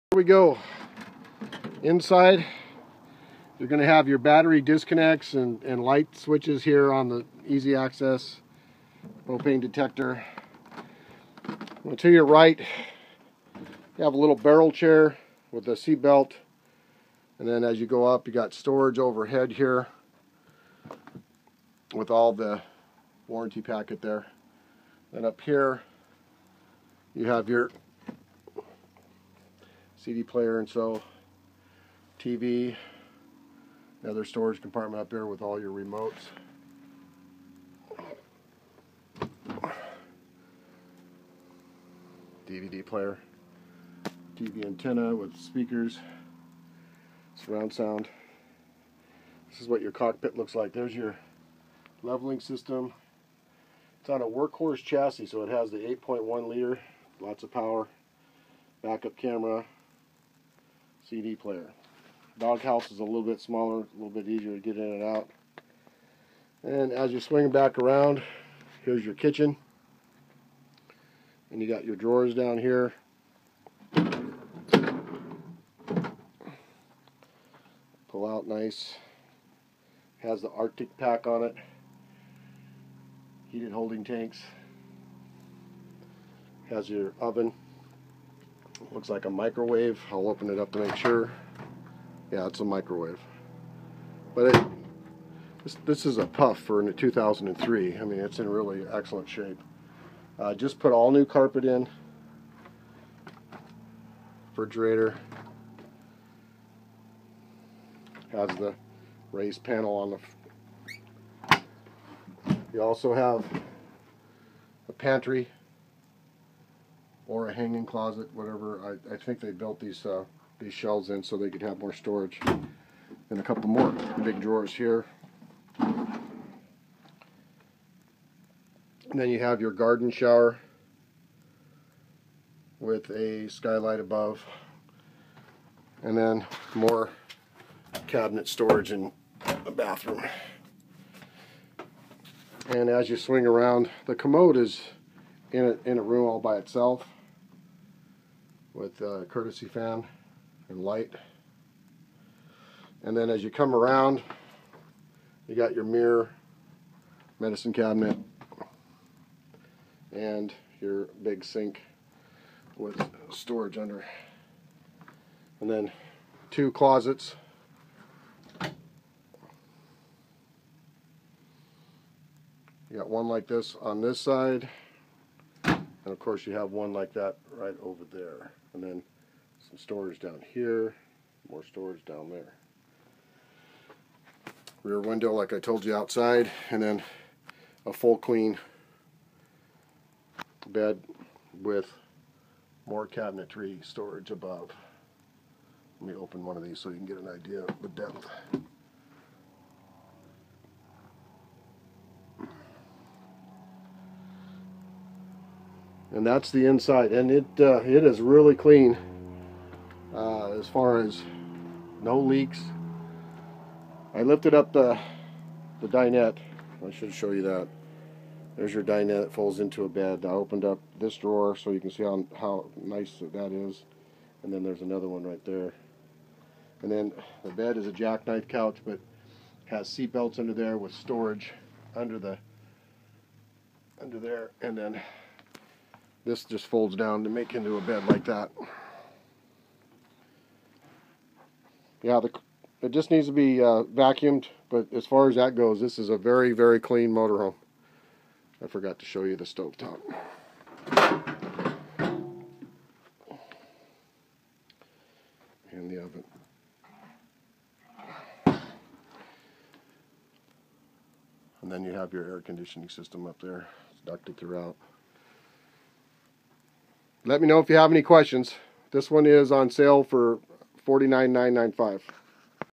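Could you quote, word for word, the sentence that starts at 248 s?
I forgot to show you the stove top.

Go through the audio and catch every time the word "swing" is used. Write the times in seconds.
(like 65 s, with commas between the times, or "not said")
67 s, 143 s.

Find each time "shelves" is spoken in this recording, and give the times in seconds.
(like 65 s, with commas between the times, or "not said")
120 s.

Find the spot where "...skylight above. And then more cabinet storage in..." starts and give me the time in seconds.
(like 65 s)
133 s.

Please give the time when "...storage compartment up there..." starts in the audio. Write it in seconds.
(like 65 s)
34 s.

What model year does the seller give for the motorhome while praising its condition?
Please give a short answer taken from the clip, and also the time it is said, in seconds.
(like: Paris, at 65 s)
2003, at 96 s.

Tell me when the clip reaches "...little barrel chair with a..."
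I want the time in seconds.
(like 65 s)
14 s.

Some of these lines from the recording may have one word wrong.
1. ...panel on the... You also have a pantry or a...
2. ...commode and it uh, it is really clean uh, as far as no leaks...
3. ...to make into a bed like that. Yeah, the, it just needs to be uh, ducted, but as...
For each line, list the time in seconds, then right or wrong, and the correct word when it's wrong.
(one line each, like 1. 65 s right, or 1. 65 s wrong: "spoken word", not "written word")
1. 109 s right
2. 206 s wrong: "inside", not "commode"
3. 237 s wrong: "vacuumed", not "ducted".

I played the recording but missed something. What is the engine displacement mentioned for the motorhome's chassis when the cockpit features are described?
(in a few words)
8.1 liter.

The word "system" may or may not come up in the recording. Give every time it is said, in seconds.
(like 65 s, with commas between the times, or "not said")
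52 s, 262 s.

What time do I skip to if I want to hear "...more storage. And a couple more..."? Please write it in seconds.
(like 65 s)
121 s.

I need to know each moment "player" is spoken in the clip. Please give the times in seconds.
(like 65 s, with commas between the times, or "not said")
30 s, 42 s, 61 s.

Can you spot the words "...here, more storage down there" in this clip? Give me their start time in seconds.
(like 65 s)
180 s.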